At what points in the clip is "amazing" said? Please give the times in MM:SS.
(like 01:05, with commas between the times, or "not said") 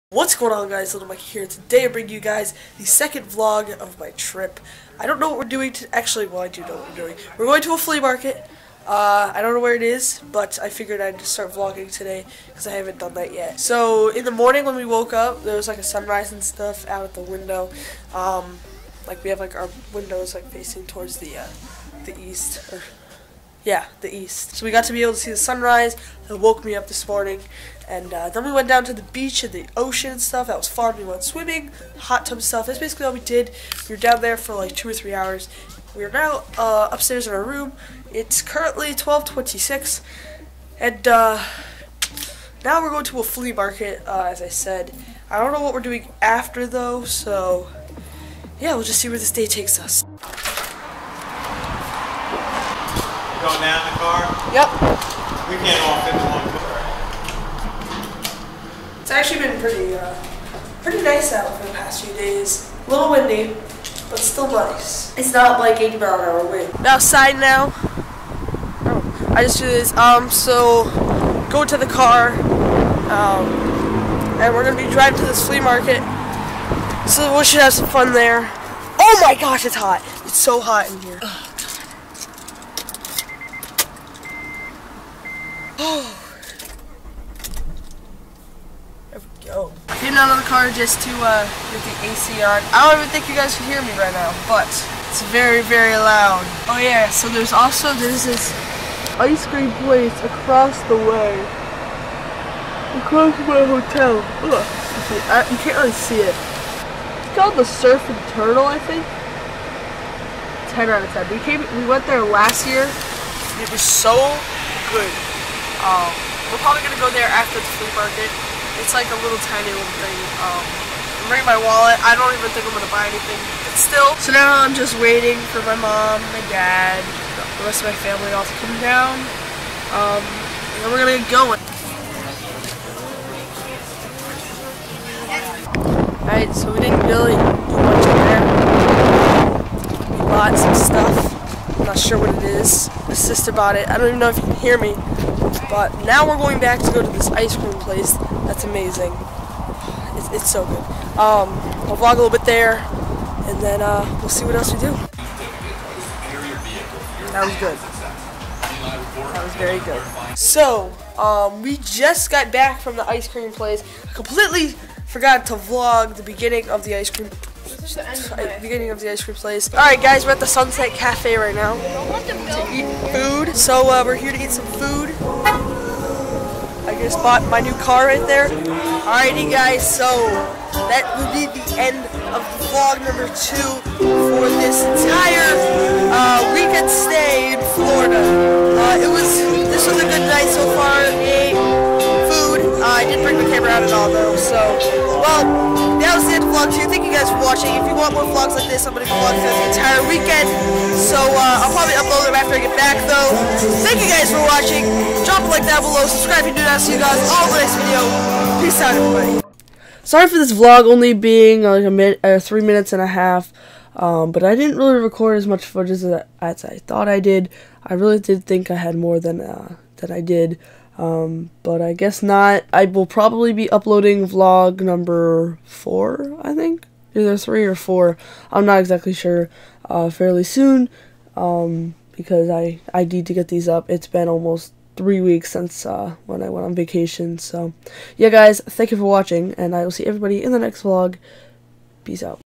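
02:28.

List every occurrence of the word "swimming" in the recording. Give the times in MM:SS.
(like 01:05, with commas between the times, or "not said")
00:31.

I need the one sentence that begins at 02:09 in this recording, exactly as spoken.
Um, and then we're gonna get going.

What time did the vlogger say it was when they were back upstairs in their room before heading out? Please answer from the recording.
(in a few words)
12:26.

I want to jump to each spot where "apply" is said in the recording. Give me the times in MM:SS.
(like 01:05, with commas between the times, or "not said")
not said.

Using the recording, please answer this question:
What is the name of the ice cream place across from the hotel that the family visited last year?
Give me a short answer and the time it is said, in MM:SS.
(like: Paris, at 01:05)
Surf and Turtle, at 01:47.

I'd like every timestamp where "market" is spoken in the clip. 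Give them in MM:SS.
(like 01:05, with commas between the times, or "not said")
00:08, 00:43, 01:15, 01:57.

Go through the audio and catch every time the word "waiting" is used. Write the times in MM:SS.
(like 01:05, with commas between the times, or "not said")
02:05.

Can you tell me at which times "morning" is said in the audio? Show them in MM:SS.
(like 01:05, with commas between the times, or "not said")
00:14, 00:27.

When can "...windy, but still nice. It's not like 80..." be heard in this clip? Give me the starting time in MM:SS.
01:03.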